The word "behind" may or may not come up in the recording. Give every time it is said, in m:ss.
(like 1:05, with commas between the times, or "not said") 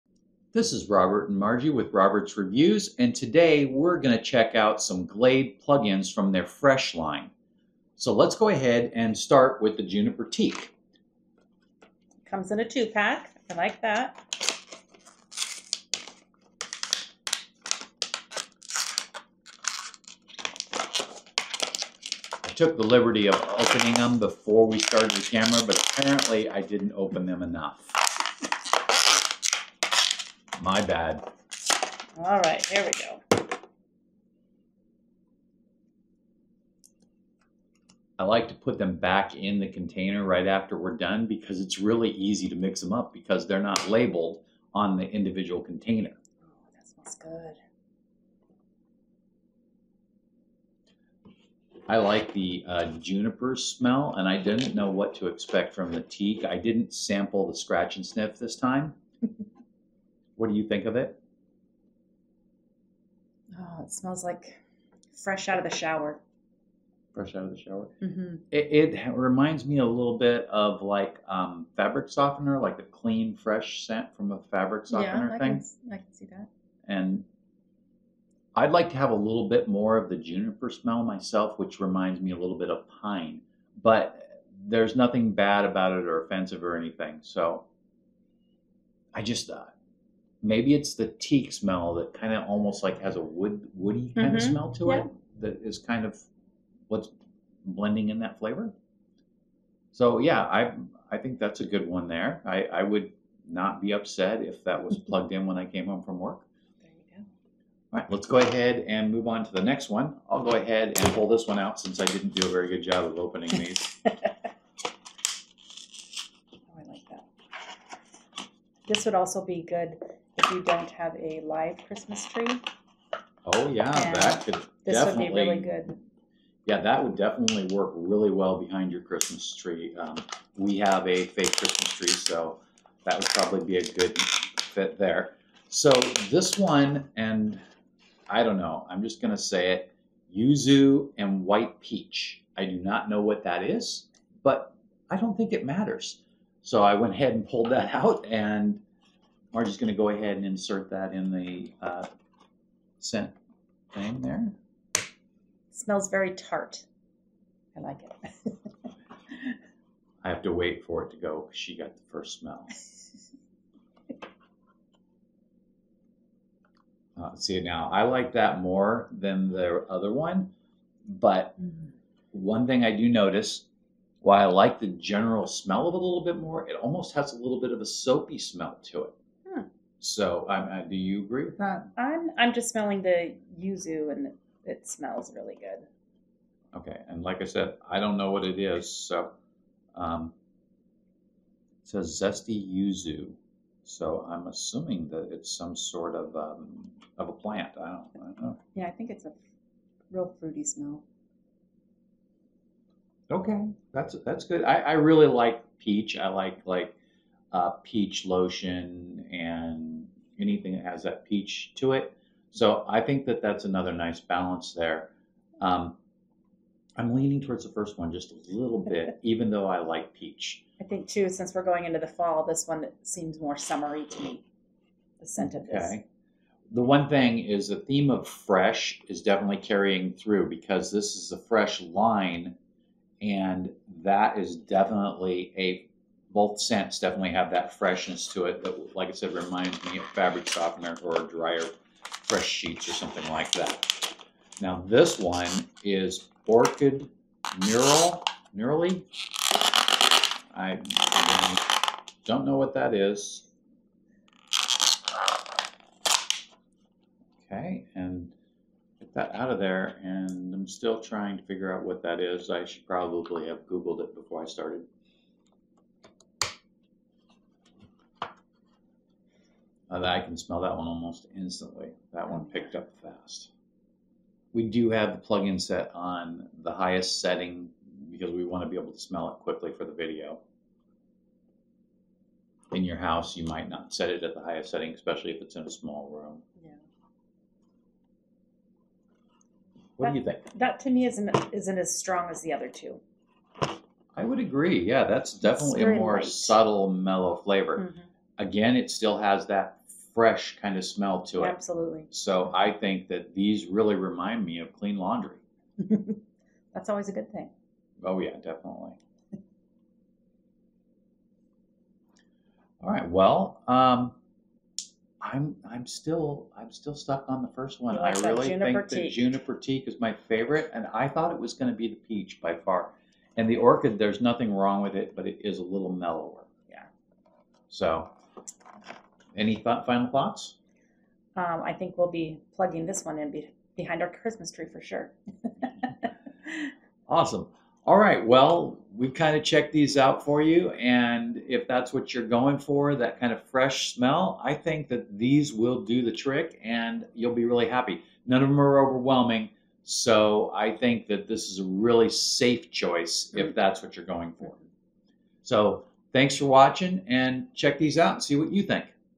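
2:08, 5:33.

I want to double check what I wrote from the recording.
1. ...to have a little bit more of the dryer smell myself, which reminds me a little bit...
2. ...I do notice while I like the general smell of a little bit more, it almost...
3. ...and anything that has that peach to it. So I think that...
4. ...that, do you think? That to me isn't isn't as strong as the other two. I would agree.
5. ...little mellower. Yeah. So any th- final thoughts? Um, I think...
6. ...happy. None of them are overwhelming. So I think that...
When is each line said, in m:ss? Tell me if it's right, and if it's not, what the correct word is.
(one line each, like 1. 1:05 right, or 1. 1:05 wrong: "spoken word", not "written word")
1. 1:18 wrong: "juniper", not "dryer"
2. 2:52 right
3. 3:29 right
4. 4:50 right
5. 5:25 right
6. 5:47 right.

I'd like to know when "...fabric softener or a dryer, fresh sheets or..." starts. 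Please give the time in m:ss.
4:00.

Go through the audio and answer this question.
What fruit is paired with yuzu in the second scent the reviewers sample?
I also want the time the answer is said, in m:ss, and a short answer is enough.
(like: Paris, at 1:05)
White peach, at 2:21.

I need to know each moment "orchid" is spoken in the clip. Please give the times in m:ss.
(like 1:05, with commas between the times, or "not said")
4:06, 5:23.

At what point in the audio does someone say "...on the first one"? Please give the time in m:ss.
5:17.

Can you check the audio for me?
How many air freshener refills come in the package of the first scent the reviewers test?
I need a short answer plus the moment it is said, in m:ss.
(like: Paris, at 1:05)
2, at 0:12.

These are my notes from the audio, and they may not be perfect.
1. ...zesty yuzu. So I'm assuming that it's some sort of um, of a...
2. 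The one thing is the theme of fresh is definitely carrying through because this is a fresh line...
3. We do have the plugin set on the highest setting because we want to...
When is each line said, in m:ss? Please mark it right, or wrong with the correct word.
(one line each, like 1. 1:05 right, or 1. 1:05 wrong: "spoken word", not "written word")
1. 3:12 right
2. 3:46 right
3. 4:34 right.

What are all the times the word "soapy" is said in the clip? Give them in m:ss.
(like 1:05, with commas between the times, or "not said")
2:57.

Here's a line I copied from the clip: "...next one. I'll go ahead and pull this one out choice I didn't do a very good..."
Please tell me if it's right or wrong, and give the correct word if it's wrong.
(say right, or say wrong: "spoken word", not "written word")
wrong: "since", not "choice".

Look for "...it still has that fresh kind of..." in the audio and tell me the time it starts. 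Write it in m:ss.
4:58.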